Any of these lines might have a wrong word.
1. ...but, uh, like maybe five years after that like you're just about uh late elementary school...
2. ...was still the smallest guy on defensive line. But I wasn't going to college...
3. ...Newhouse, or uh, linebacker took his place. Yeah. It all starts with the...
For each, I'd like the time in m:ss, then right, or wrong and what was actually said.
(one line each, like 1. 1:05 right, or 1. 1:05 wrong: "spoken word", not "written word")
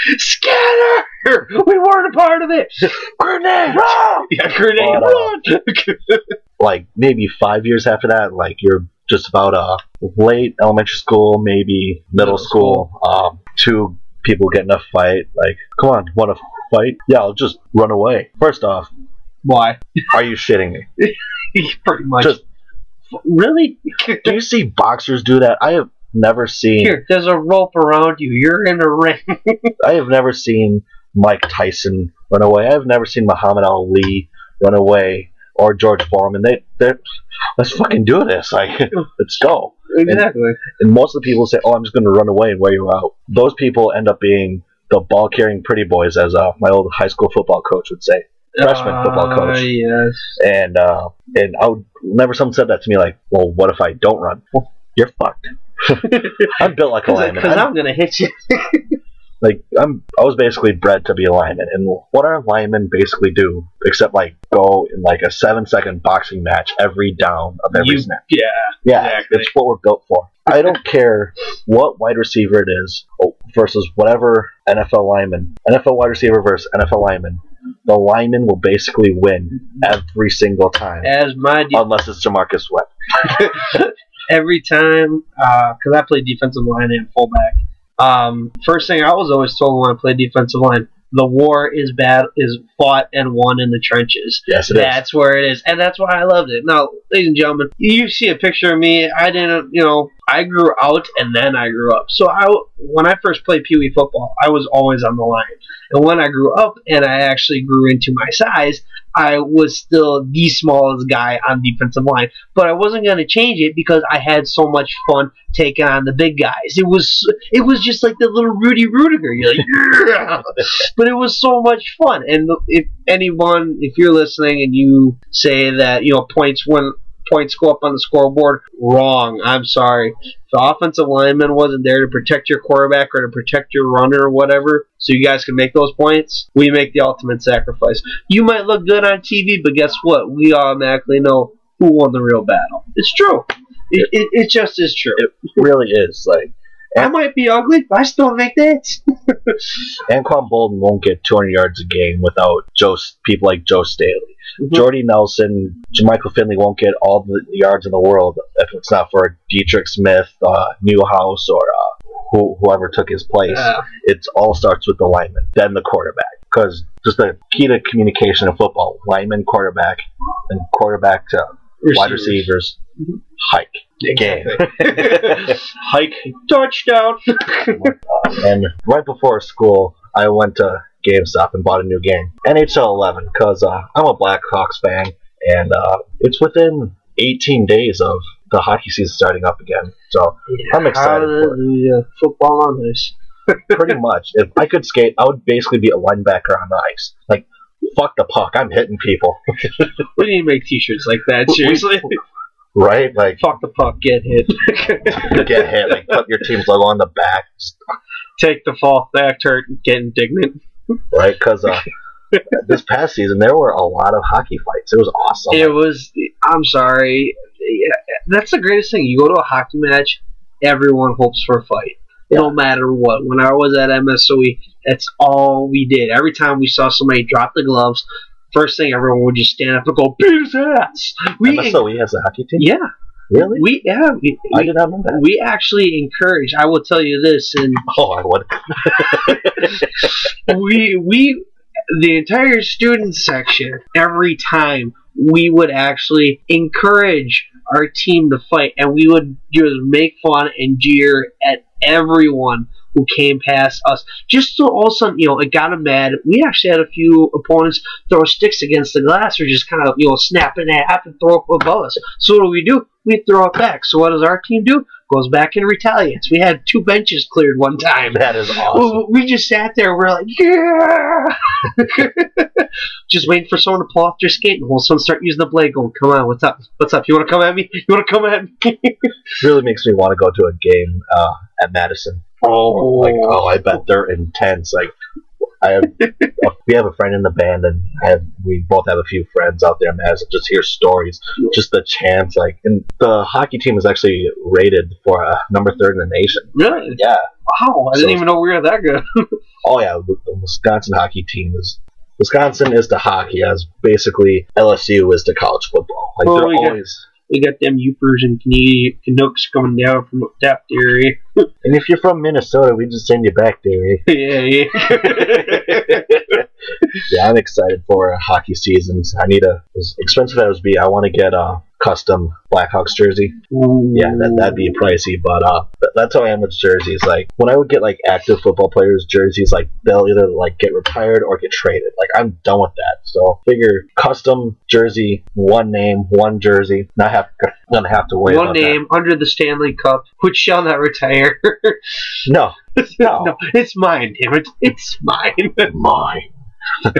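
1. 0:05 right
2. 1:49 wrong: "change", not "college"
3. 2:40 wrong: "whoever", not "linebacker".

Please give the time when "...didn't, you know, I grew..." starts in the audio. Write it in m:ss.
1:39.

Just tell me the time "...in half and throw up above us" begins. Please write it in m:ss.
4:20.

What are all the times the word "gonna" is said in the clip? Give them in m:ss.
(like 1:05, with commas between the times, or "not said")
0:57, 5:37.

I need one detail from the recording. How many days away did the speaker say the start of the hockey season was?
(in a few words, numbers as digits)
18.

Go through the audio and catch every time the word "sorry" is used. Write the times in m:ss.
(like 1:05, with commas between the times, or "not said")
2:09, 3:36.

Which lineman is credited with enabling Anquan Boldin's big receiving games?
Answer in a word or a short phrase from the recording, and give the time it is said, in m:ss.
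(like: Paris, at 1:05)
Joe Staley, at 2:33.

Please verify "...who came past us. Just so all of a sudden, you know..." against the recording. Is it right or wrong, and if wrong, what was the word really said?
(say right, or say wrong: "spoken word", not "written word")
right.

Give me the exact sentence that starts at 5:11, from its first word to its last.
and if you're from Minnesota, we just send you back there.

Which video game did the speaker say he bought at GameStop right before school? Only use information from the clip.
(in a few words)
NHL 11.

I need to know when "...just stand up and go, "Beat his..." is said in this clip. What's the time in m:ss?
3:49.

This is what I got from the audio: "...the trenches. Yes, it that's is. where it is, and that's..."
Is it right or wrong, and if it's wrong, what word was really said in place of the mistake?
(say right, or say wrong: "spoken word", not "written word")
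right.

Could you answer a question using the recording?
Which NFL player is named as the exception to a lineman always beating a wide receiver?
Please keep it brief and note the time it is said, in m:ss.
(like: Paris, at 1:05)
J'Marcus Webb, at 1:22.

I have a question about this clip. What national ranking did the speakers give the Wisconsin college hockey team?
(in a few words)
third.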